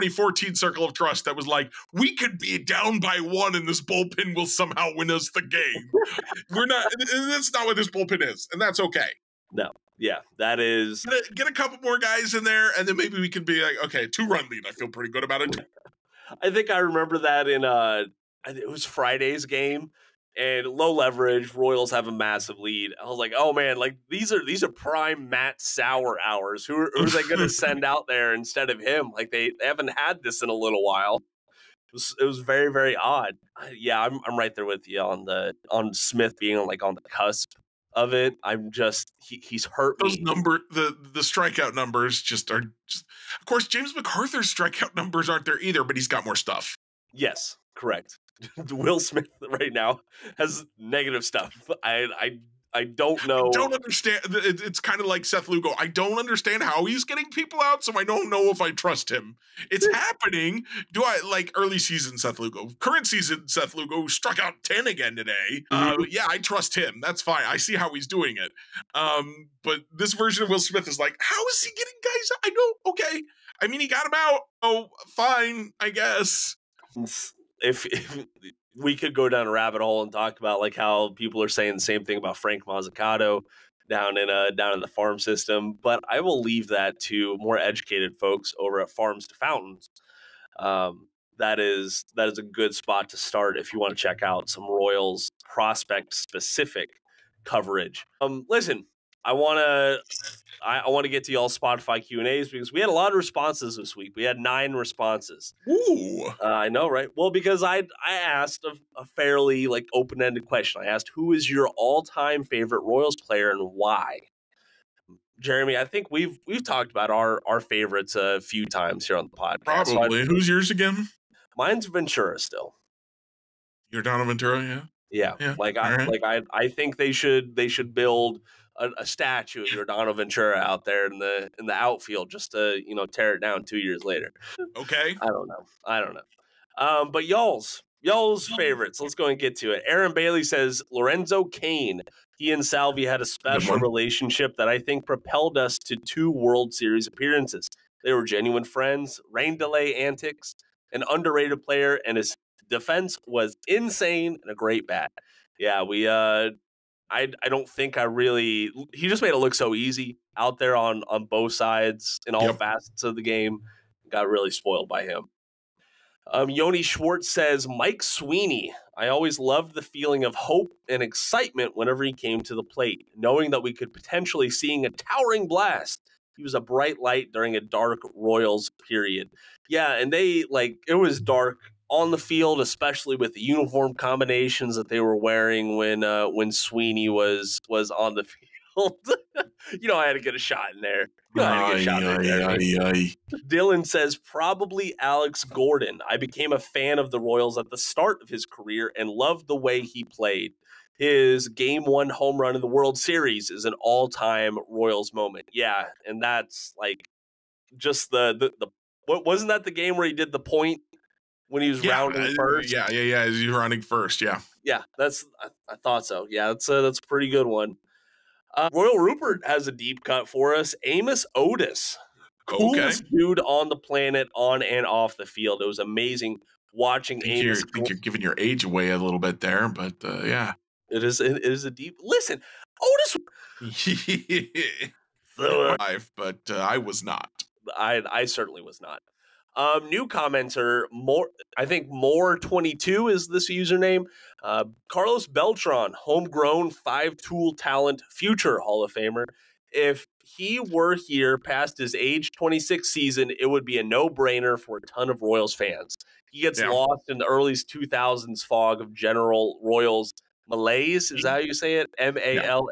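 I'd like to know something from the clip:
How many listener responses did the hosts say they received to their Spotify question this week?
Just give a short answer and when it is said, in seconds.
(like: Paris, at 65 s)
9, at 104 s.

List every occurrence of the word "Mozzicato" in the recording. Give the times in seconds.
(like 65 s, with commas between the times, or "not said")
82 s.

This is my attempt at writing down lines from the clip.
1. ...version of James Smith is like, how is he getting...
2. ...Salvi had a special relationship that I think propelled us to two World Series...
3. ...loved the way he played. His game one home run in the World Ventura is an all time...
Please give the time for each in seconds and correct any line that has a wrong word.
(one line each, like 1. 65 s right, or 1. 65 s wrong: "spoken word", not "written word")
1. 70 s wrong: "Will", not "James"
2. 142 s right
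3. 199 s wrong: "Series", not "Ventura".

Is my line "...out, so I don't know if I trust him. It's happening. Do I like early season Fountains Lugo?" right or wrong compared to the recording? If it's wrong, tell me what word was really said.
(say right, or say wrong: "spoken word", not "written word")
wrong: "Seth", not "Fountains".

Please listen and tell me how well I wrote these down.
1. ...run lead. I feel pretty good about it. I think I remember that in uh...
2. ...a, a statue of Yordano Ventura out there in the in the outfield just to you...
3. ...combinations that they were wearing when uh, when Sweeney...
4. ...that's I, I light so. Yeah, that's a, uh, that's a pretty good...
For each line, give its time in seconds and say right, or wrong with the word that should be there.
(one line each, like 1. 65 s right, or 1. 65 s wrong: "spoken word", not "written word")
1. 14 s right
2. 128 s right
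3. 183 s right
4. 214 s wrong: "thought", not "light".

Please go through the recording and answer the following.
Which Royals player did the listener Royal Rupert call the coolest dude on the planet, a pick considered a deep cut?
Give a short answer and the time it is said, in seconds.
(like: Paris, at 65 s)
Amos Otis, at 220 s.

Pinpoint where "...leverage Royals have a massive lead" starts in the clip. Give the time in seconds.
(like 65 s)
20 s.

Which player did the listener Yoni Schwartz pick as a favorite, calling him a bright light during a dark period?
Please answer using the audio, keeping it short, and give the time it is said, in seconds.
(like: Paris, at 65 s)
Mike Sweeney, at 167 s.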